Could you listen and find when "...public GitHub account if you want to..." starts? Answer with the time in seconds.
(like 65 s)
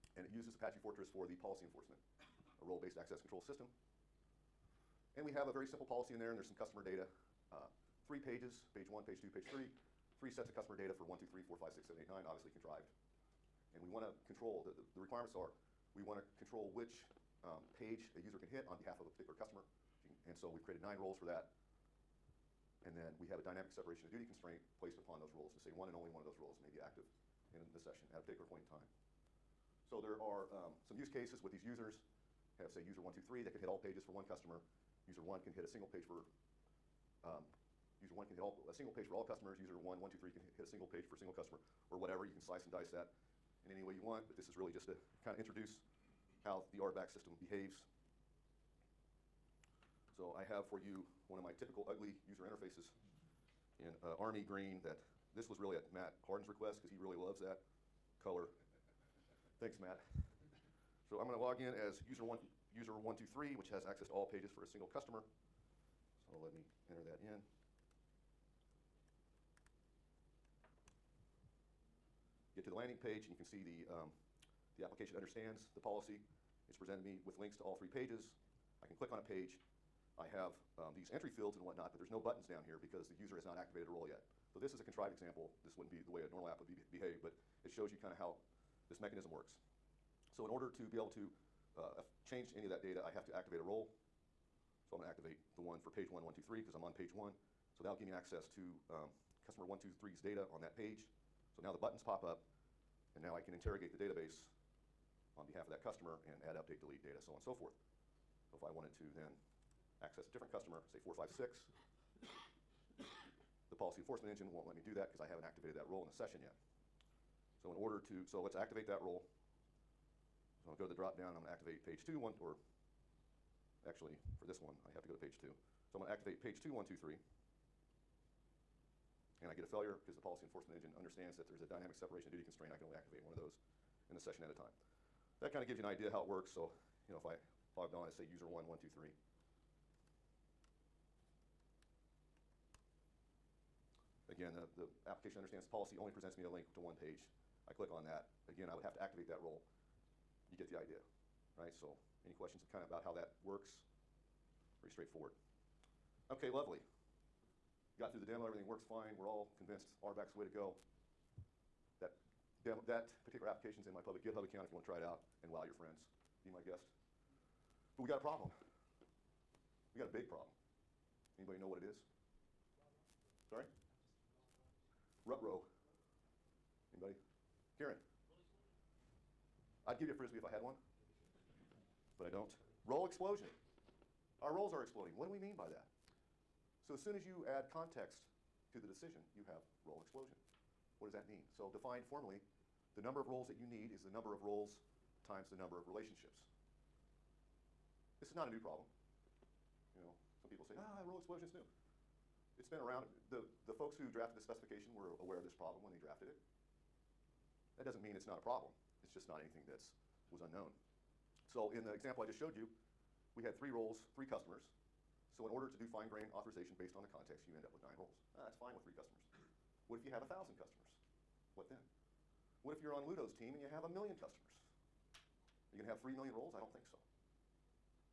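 164 s.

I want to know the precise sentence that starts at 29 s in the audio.
So there are um, some use cases with these users.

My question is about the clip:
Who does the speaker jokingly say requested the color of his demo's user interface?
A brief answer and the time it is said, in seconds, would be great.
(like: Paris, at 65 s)
Matt Hardin, at 55 s.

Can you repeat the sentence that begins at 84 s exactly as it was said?
So this is a contrived example.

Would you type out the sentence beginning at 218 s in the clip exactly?
Ah, that's fine with three customers.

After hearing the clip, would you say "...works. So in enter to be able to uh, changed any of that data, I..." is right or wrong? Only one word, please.
wrong.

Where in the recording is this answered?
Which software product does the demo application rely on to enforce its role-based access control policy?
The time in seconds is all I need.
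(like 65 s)
0 s.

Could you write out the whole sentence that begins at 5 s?
And we have a very simple policy in there, and there's some customer data.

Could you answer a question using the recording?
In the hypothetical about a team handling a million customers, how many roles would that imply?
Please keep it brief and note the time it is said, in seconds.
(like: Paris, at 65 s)
3 million, at 225 s.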